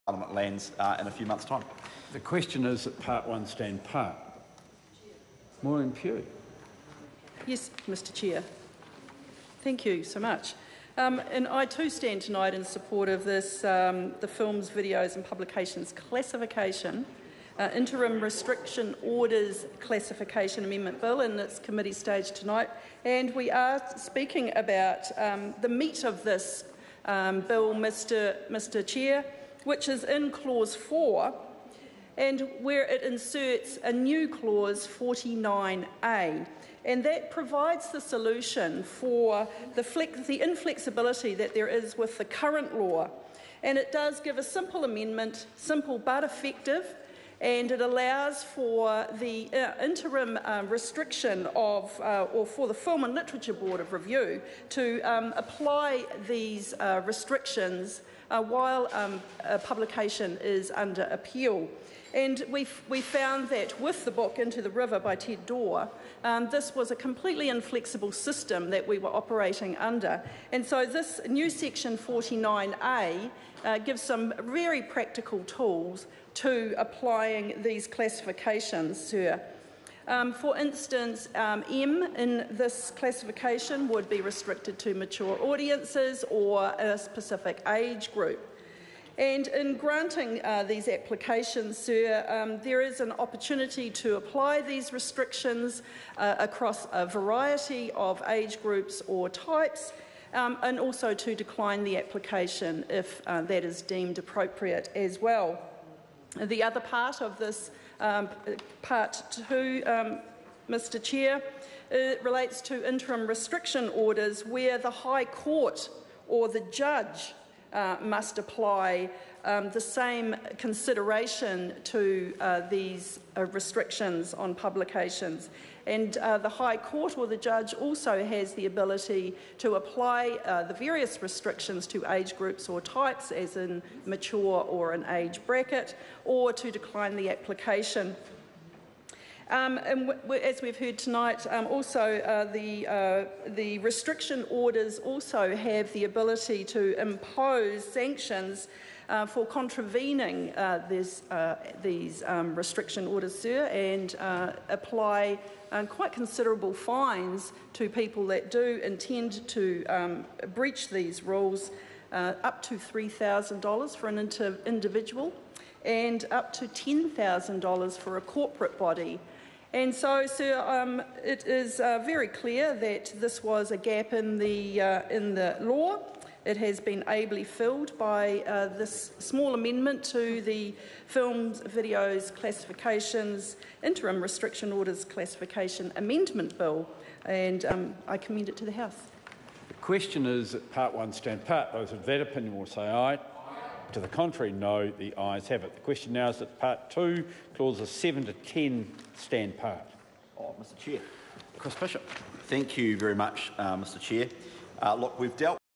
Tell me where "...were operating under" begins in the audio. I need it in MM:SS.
01:08.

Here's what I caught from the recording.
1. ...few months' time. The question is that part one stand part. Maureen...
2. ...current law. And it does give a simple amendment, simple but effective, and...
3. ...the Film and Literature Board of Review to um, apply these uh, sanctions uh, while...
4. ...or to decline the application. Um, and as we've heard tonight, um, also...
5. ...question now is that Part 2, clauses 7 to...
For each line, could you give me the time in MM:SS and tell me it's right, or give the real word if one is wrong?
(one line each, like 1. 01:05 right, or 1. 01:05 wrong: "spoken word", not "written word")
1. 00:01 right
2. 00:42 right
3. 00:52 wrong: "restrictions", not "sanctions"
4. 02:16 right
5. 03:15 right.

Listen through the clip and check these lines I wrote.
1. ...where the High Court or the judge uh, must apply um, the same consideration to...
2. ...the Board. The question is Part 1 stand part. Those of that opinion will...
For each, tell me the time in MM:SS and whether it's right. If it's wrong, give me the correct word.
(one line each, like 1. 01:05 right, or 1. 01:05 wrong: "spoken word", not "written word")
1. 01:54 right
2. 03:08 wrong: "House", not "Board".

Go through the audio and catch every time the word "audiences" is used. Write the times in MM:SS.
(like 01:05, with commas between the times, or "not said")
01:25.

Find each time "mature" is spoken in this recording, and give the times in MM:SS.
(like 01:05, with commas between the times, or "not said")
01:24, 02:14.